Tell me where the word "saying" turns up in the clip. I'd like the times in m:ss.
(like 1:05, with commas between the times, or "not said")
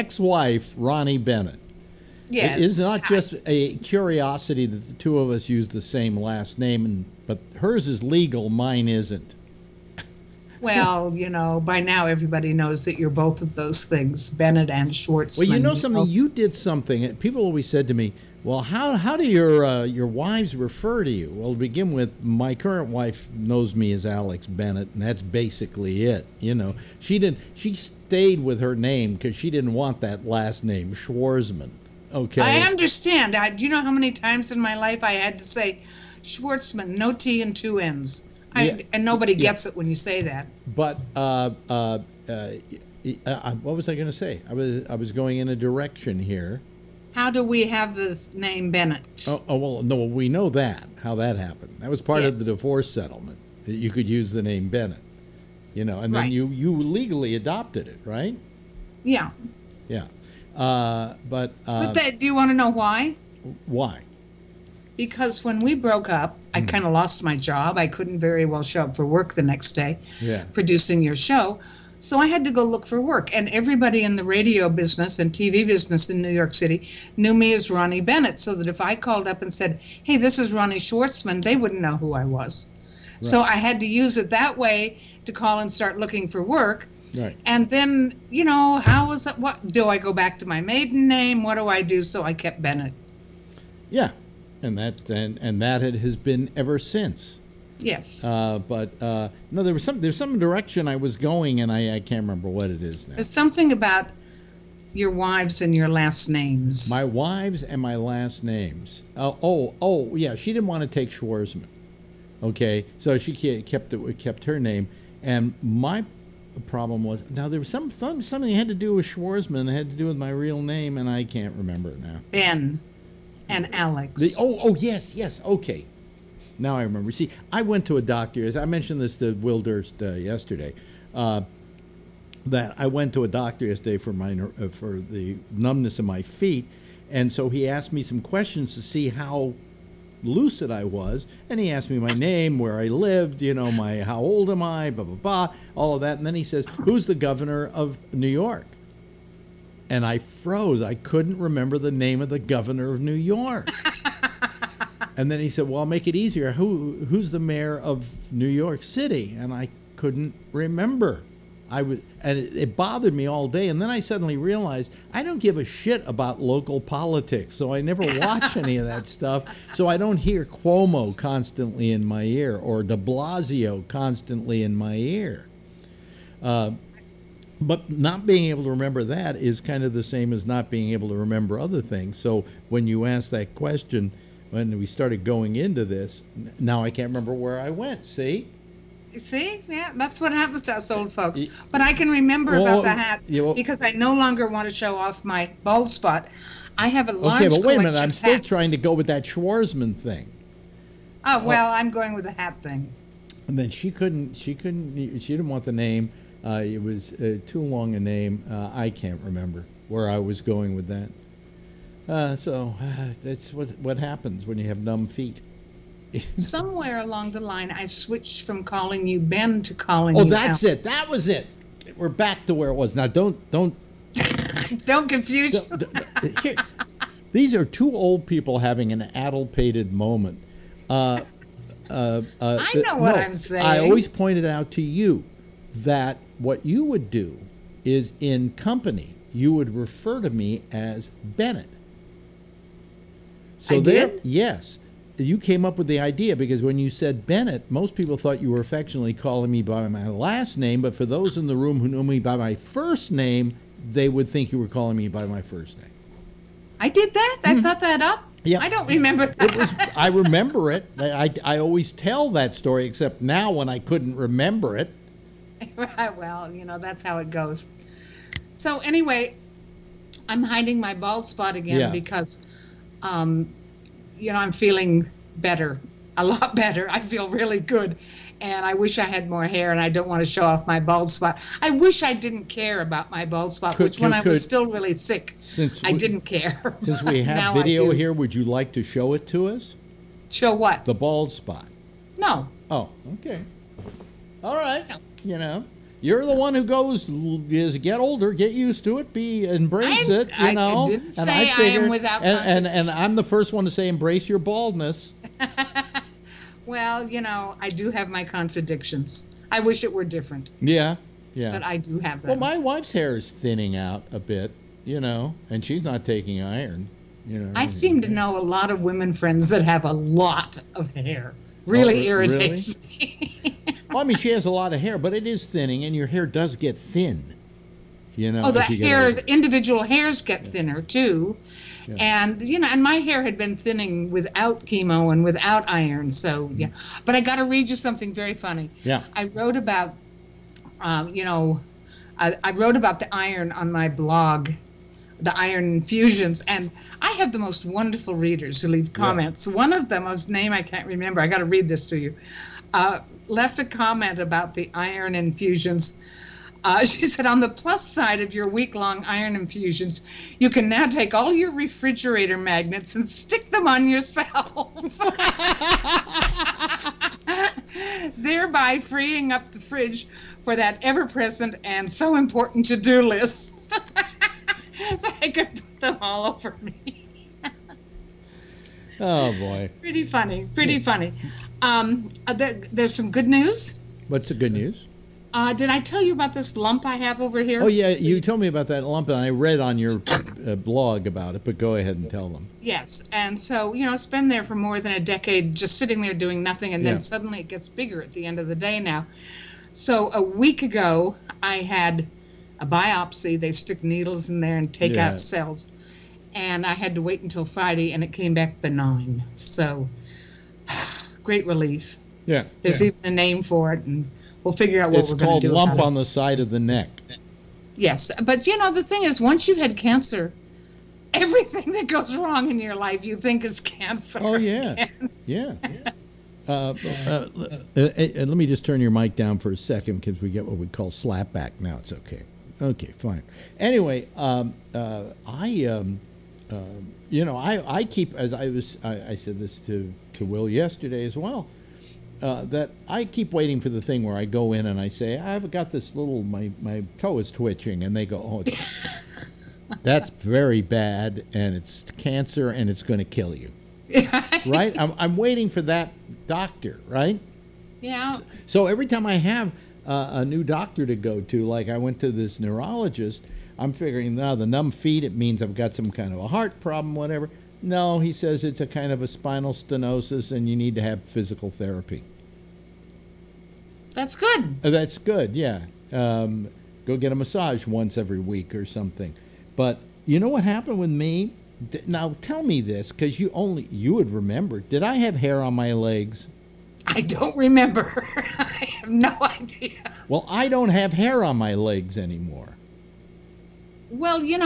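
3:53.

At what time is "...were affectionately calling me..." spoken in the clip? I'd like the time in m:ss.
4:08.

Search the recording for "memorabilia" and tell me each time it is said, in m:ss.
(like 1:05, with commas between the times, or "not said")
not said.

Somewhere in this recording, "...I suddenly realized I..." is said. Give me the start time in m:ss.
2:43.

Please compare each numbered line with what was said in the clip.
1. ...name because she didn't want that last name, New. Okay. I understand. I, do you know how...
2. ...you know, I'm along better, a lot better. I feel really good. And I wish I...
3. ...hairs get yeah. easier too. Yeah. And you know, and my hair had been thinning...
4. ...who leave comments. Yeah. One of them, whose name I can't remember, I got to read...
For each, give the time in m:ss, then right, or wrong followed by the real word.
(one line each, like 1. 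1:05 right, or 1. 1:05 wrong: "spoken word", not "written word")
1. 0:28 wrong: "Schwartzman", not "New"
2. 4:34 wrong: "feeling", not "along"
3. 5:29 wrong: "thinner", not "easier"
4. 5:48 right.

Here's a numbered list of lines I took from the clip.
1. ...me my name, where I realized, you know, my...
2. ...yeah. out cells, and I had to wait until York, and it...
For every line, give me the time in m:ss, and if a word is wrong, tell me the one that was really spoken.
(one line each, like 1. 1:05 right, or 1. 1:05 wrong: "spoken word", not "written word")
1. 2:21 wrong: "lived", not "realized"
2. 6:44 wrong: "Friday", not "York".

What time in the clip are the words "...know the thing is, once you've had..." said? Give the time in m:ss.
6:58.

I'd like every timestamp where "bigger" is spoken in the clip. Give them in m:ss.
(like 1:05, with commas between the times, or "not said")
6:37.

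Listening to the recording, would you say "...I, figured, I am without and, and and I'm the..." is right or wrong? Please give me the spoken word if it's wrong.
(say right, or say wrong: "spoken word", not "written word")
right.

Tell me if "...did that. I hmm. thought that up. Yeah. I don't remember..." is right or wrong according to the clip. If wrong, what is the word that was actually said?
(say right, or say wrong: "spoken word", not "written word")
right.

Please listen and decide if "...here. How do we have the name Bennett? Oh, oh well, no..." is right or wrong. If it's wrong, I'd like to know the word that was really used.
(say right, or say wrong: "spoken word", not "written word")
right.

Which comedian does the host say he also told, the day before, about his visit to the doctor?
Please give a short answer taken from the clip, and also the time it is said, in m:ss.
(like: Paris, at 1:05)
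Will Durst, at 2:09.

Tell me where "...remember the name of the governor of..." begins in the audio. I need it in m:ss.
2:31.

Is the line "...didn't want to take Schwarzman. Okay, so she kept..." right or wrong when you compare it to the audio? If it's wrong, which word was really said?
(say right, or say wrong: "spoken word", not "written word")
right.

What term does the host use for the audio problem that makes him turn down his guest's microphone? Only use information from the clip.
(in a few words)
slapback.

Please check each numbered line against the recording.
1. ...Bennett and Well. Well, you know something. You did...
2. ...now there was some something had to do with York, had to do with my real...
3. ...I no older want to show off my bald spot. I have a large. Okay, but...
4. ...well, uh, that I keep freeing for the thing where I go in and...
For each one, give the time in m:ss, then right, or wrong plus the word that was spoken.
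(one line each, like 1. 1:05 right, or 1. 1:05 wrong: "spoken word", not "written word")
1. 0:14 wrong: "Schwartz", not "Well"
2. 1:57 wrong: "Schwarzman", not "York"
3. 3:13 wrong: "longer", not "older"
4. 7:21 wrong: "waiting", not "freeing".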